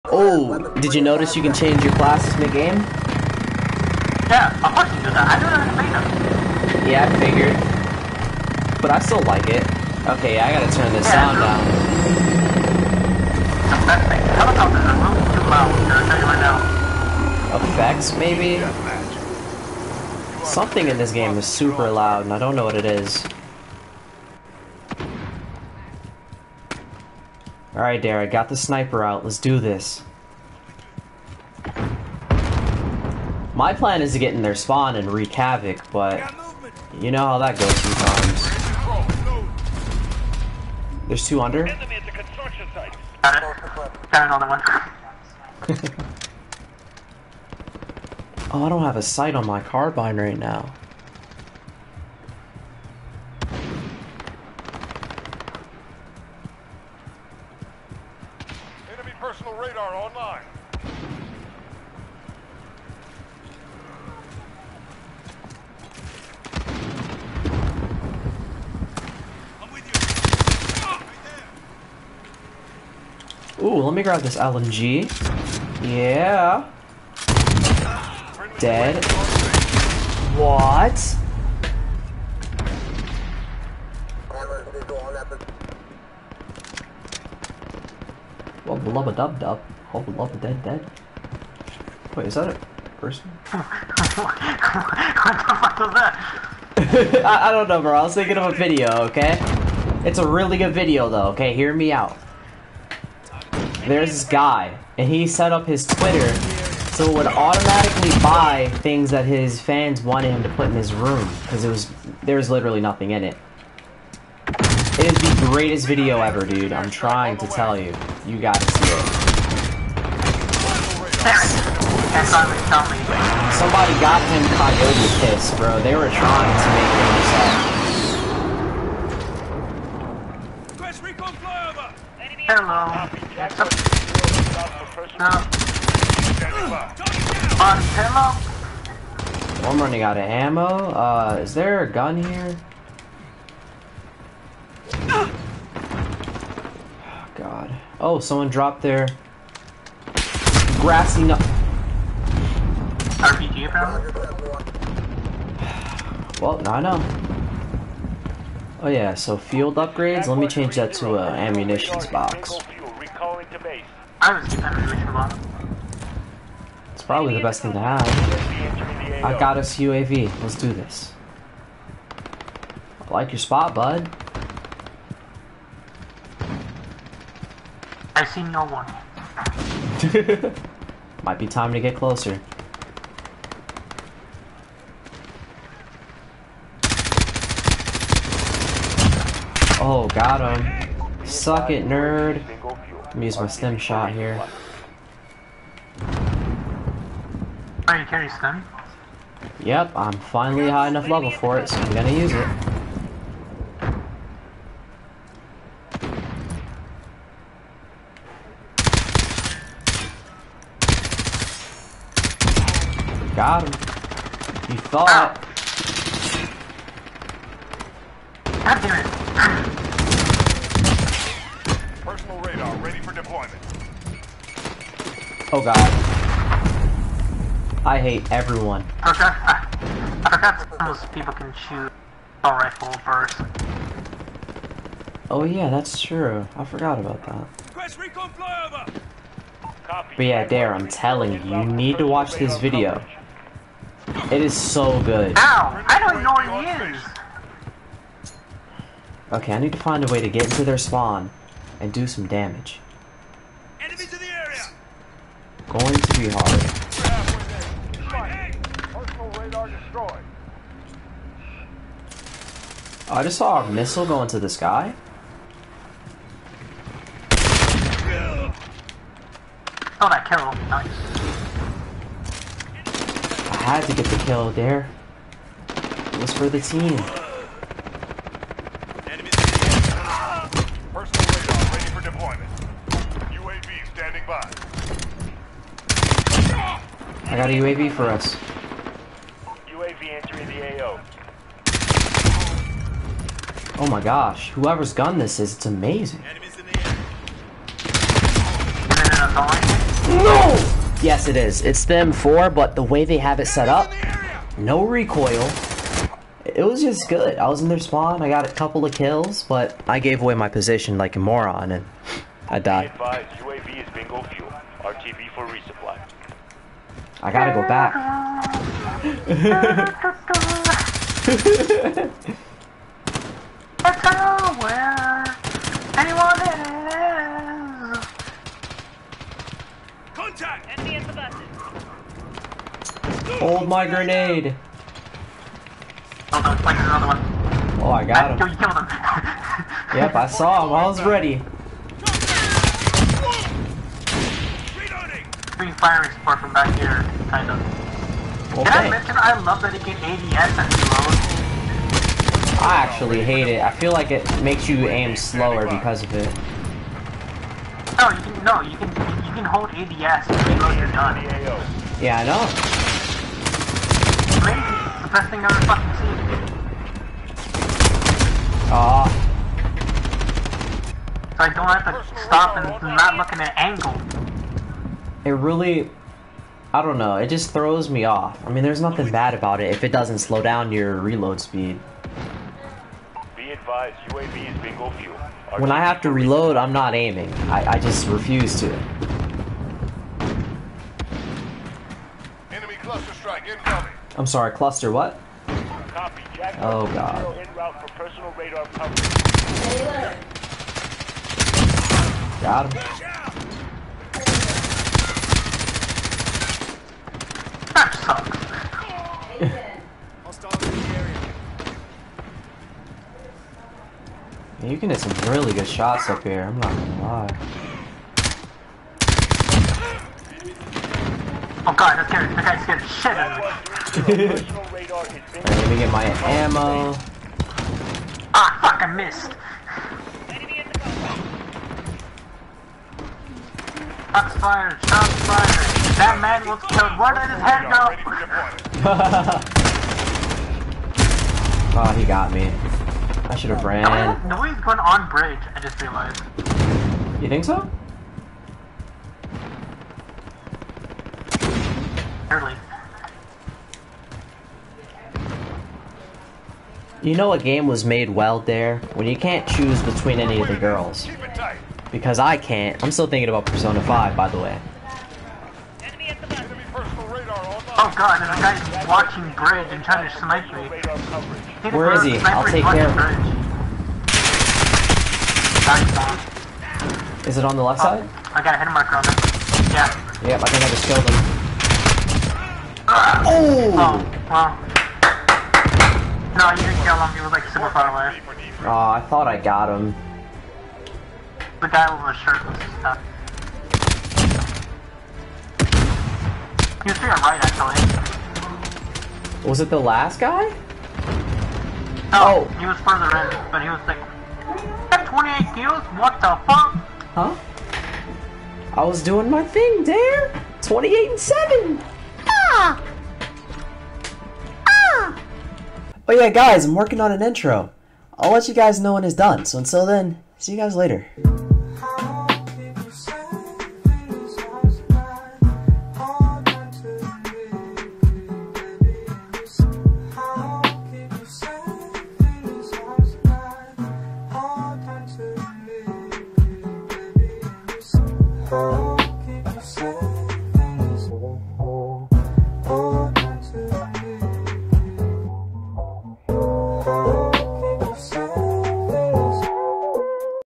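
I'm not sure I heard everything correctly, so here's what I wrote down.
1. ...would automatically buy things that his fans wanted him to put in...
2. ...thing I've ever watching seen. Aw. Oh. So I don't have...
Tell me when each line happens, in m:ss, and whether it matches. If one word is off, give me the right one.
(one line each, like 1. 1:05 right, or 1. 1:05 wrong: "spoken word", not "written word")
1. 1:47 right
2. 6:05 wrong: "fucking", not "watching".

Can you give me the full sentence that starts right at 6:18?
I mean, there's nothing bad about it if it doesn't slow down your reload speed.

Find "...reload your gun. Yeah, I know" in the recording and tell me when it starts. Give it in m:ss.
6:00.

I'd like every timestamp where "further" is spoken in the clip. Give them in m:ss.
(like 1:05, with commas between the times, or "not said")
8:22.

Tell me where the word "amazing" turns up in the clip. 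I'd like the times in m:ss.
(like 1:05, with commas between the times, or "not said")
4:55, 6:04.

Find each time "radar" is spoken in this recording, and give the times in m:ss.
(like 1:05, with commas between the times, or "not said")
0:59, 4:41, 6:38.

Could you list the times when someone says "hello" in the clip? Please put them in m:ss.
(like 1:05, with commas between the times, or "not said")
2:12, 2:17.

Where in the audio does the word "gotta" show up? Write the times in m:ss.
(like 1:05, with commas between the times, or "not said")
0:10, 1:58.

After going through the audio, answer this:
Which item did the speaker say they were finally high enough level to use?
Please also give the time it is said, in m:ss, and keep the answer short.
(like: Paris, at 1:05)
stim shot, at 3:13.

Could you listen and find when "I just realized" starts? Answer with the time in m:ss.
7:25.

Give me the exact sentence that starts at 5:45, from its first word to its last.
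free firing support from back here, kind of.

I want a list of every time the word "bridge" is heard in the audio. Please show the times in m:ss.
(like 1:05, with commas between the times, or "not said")
7:25, 7:49.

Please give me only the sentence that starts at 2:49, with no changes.
I got us UAV, let's do this.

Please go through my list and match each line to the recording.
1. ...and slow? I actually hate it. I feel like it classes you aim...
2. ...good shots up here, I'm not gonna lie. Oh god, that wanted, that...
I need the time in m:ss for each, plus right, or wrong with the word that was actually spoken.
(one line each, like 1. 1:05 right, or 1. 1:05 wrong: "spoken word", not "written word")
1. 5:50 wrong: "makes", not "classes"
2. 6:55 wrong: "scared", not "wanted".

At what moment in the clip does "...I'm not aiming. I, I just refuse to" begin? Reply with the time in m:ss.
6:26.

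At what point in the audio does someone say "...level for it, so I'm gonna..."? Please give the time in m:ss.
3:21.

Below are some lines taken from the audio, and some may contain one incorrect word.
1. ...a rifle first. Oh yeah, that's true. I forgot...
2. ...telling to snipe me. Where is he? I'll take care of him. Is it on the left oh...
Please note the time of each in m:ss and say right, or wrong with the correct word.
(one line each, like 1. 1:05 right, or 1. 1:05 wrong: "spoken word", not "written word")
1. 3:52 right
2. 7:49 wrong: "trying", not "telling".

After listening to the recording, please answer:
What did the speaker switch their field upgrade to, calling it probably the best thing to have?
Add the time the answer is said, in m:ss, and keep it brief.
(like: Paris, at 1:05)
ammunitions box, at 2:41.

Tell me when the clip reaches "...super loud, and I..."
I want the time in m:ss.
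0:21.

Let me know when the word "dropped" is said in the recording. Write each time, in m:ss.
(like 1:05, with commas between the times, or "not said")
2:28.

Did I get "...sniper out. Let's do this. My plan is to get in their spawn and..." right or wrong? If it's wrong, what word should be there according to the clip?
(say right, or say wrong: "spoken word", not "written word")
right.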